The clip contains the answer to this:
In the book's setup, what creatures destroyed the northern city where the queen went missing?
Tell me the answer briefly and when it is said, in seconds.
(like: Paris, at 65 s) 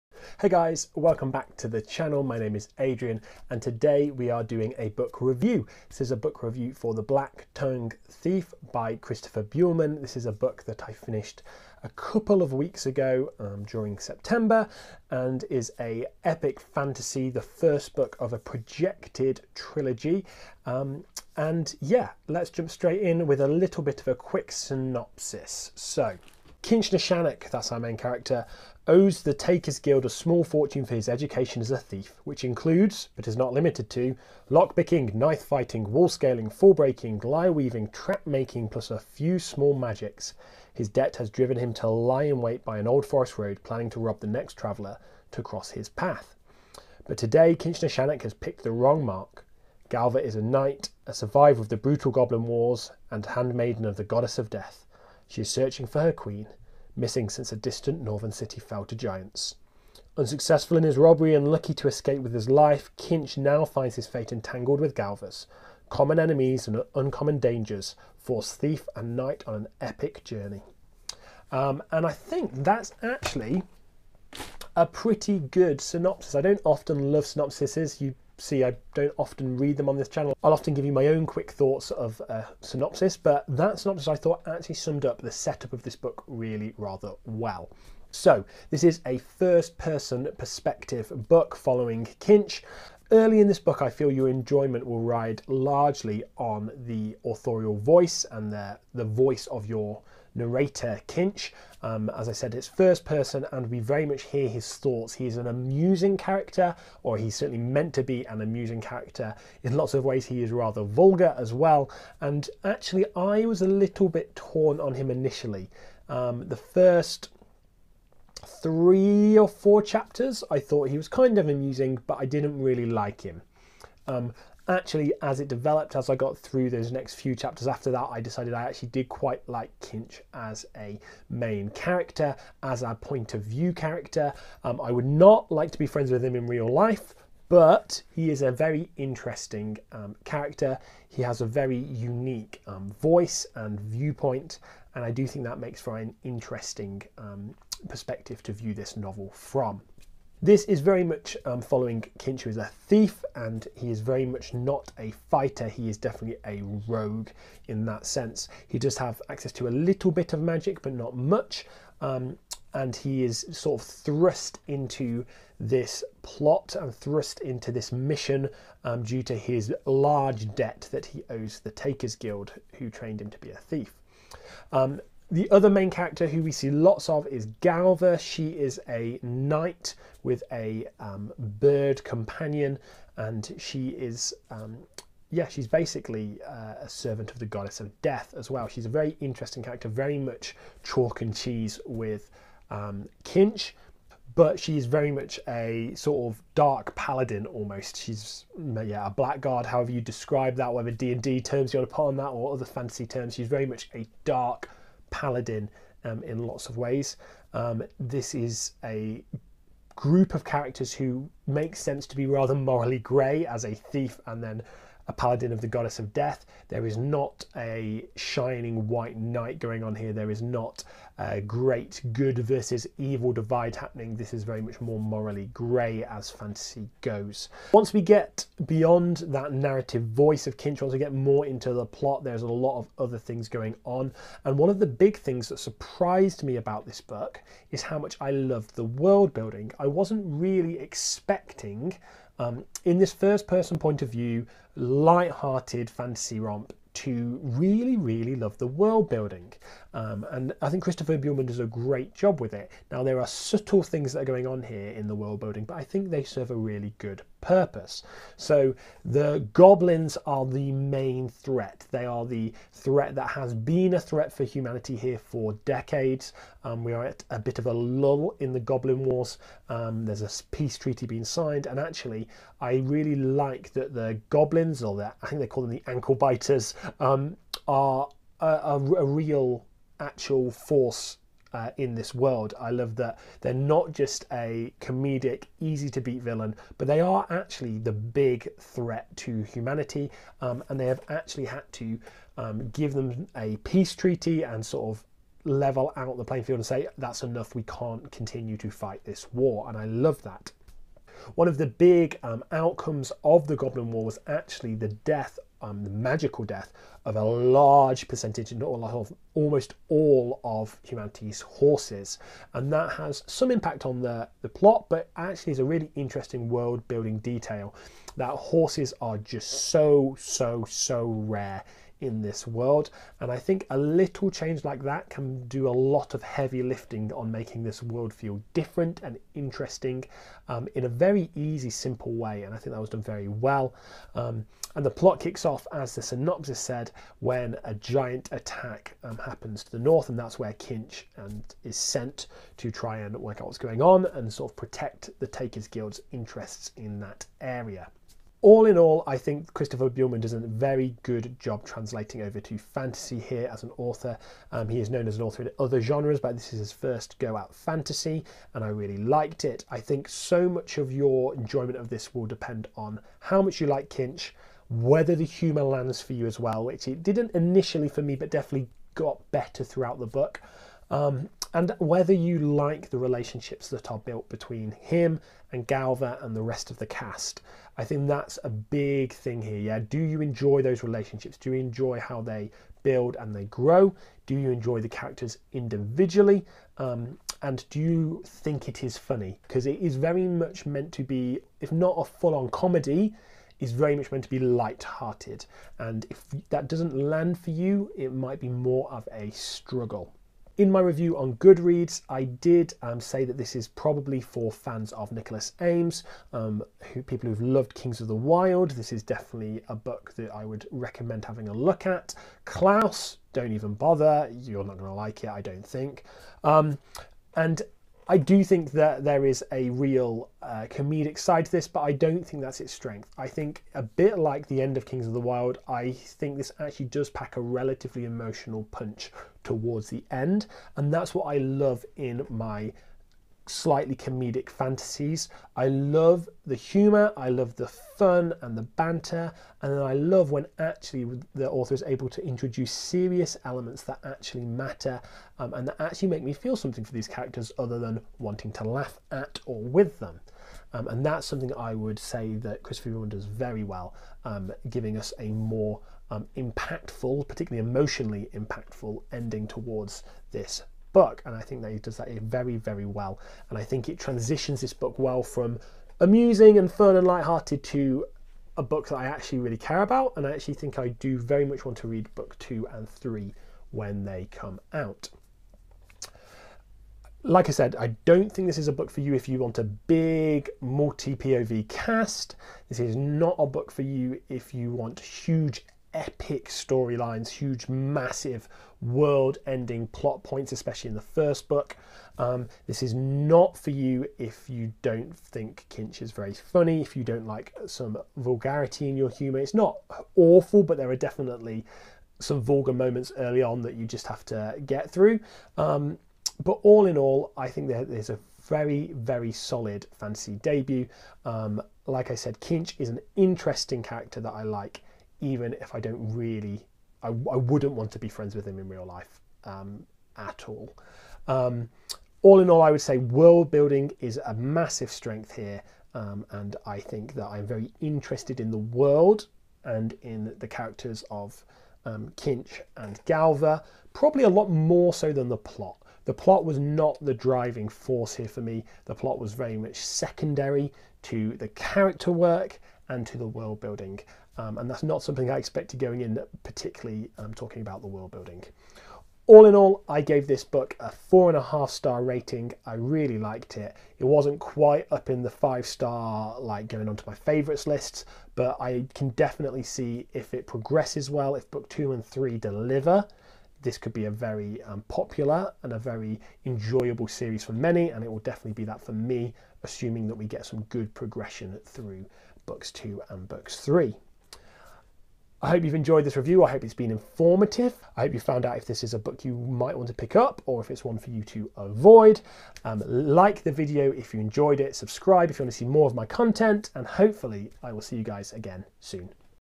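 giants, at 58 s.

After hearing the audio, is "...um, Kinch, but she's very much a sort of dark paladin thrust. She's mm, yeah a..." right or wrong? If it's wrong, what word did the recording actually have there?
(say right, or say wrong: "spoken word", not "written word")
wrong: "almost", not "thrust".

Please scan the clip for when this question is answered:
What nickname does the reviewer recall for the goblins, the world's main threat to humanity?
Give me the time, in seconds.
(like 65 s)
275 s.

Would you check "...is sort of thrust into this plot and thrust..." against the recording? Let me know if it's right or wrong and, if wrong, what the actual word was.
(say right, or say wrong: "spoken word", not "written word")
right.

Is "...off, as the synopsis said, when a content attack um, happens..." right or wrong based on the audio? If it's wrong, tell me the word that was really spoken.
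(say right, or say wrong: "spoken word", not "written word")
wrong: "giant", not "content".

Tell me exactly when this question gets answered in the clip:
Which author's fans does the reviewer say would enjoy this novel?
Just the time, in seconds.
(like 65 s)
405 s.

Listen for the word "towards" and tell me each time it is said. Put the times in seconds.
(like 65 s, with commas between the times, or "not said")
429 s, 459 s.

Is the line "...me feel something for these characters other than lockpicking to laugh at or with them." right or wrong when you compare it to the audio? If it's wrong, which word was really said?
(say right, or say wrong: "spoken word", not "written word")
wrong: "wanting", not "lockpicking".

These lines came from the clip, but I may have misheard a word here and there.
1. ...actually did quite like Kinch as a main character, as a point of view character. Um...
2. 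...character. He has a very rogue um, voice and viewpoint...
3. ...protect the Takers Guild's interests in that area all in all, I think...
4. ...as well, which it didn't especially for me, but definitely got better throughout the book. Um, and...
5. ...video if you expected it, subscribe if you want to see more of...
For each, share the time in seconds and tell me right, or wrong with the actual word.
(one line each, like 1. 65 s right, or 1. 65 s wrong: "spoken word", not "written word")
1. 128 s right
2. 140 s wrong: "unique", not "rogue"
3. 344 s right
4. 366 s wrong: "initially", not "especially"
5. 583 s wrong: "enjoyed", not "expected".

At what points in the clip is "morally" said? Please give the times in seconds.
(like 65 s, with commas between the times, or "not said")
212 s, 224 s.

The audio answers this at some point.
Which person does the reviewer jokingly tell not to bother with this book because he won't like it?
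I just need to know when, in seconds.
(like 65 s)
412 s.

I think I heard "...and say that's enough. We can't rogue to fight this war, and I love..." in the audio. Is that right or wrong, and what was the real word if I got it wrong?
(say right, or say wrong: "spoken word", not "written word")
wrong: "continue", not "rogue".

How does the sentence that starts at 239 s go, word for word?
I wasn't really expecting um, in this first person point of view, light-hearted fantasy romp to really, really love the world building.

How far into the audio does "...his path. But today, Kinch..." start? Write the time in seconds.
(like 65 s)
45 s.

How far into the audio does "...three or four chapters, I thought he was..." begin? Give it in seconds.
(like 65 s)
118 s.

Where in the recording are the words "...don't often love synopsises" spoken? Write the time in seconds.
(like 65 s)
76 s.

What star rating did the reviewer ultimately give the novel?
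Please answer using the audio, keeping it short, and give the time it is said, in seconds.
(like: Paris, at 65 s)
4.5 stars, at 550 s.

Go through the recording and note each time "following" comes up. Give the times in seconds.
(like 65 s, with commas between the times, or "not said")
91 s, 151 s.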